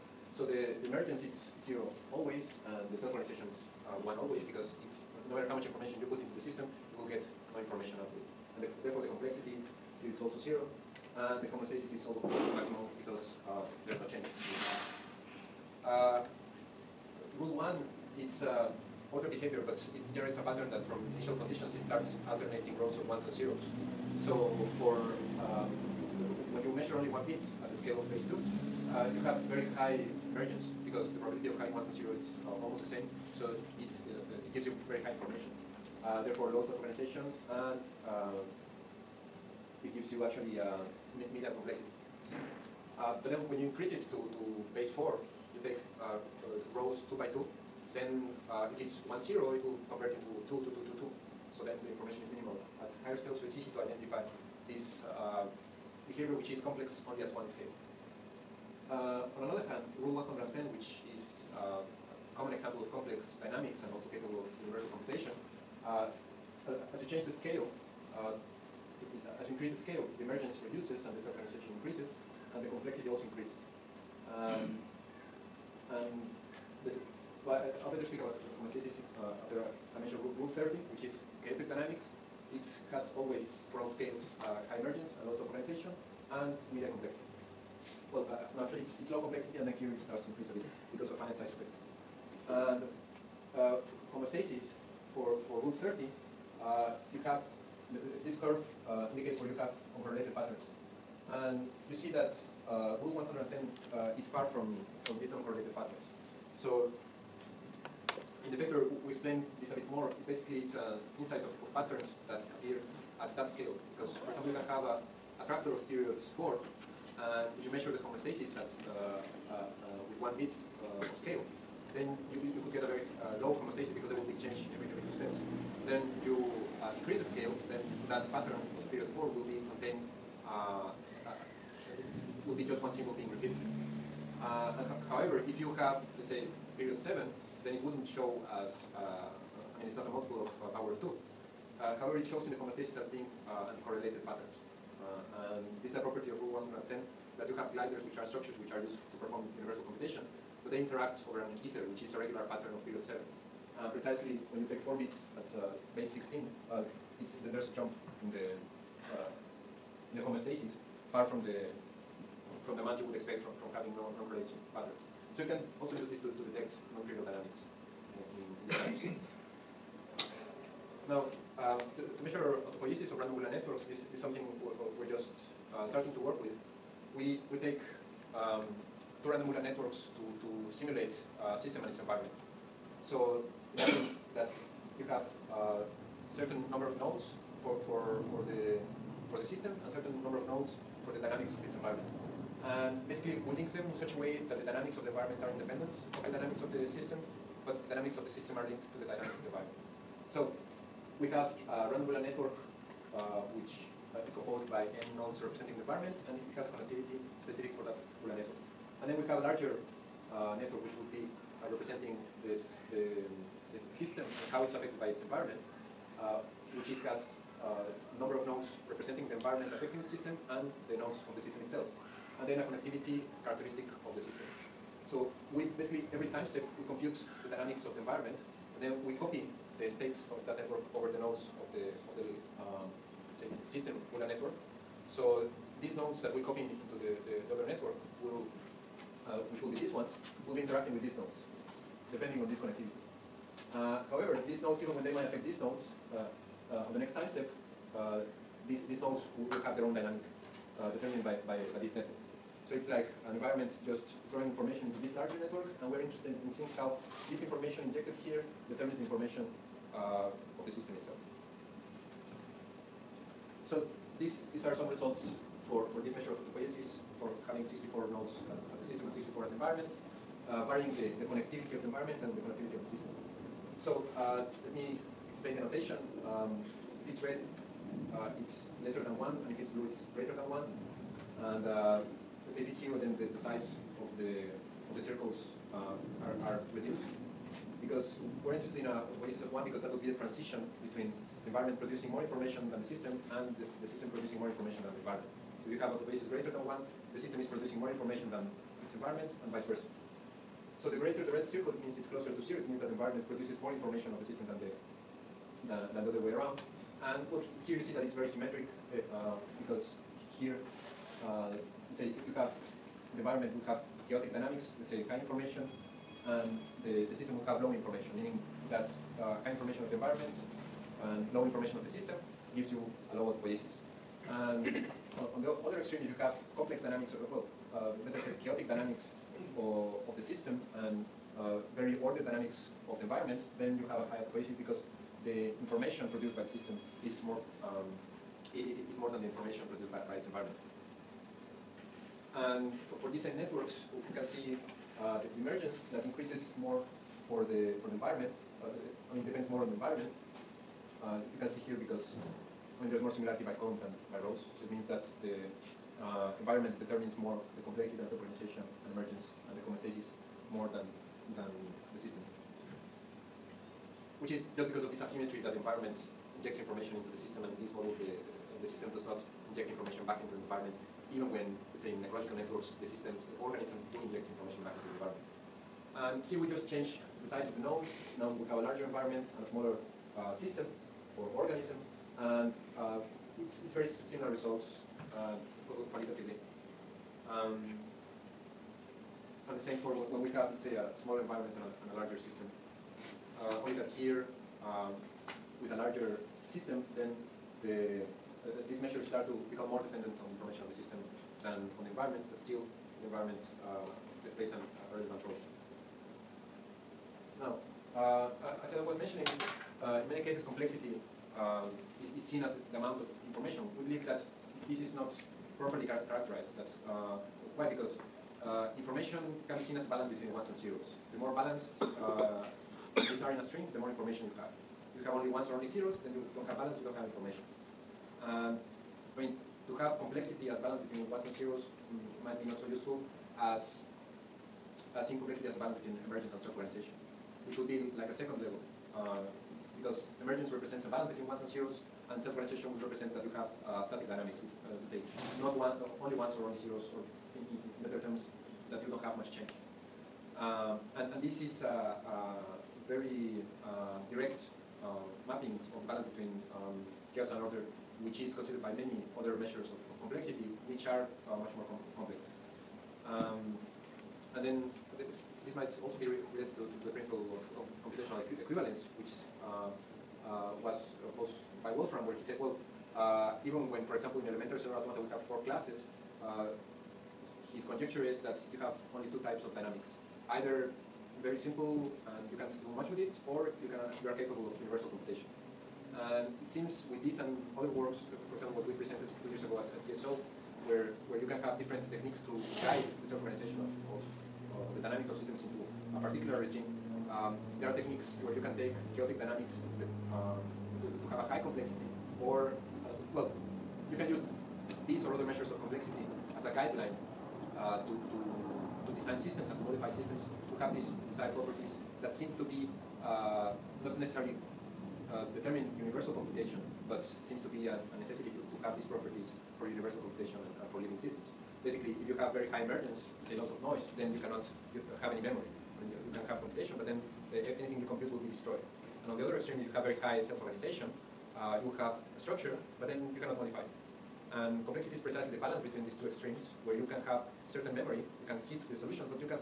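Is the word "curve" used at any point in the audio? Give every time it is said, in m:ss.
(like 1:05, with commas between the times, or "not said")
1:38.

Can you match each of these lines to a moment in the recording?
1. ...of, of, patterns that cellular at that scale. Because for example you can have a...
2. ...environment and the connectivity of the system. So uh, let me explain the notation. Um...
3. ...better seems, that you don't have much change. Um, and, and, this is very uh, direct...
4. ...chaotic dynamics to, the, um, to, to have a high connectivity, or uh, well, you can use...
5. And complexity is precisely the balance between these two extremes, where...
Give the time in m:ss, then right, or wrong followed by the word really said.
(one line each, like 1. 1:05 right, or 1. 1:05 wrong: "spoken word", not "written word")
1. 1:51 wrong: "appear", not "cellular"
2. 4:31 right
3. 7:27 wrong: "terms", not "seems"
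4. 8:18 wrong: "complexity", not "connectivity"
5. 8:54 right.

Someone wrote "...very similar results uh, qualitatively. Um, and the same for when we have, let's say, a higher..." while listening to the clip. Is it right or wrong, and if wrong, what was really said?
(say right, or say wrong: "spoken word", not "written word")
wrong: "smaller", not "higher".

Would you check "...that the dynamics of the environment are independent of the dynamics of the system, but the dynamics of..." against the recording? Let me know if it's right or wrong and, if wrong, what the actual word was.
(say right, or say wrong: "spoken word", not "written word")
right.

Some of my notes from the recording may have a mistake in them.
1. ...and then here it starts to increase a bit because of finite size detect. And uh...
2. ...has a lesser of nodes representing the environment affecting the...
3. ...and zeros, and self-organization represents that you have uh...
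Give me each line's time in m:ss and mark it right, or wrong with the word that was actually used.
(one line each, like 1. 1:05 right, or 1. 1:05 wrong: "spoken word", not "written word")
1. 1:29 wrong: "effect", not "detect"
2. 3:37 wrong: "number", not "lesser"
3. 7:21 right.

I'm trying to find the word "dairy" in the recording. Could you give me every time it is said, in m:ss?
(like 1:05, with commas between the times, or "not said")
not said.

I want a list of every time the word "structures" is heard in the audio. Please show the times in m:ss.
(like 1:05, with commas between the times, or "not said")
2:28, 8:52.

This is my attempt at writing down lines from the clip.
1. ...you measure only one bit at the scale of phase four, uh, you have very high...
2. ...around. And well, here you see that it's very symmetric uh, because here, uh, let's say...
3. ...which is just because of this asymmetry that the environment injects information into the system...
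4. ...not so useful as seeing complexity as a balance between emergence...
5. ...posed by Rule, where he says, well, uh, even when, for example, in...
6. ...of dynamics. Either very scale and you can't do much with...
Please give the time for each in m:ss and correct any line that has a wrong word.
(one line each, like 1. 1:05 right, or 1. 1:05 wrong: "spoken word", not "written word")
1. 0:26 wrong: "two", not "four"
2. 5:06 right
3. 6:04 right
4. 7:12 right
5. 7:51 wrong: "Wolfram", not "Rule"
6. 7:59 wrong: "simple", not "scale".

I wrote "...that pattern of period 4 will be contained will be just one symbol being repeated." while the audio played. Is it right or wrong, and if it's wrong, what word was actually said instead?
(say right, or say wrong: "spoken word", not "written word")
right.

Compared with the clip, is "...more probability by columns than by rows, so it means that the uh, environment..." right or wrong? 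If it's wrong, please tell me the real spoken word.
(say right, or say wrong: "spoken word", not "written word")
wrong: "similarity", not "probability".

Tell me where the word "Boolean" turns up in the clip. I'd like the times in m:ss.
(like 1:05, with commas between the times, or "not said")
2:53, 2:59, 3:22, 3:28.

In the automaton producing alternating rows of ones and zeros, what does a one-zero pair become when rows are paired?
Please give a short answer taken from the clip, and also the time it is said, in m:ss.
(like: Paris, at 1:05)
2, at 0:50.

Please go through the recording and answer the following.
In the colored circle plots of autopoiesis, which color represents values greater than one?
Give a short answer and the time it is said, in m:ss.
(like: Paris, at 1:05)
Blue, at 4:39.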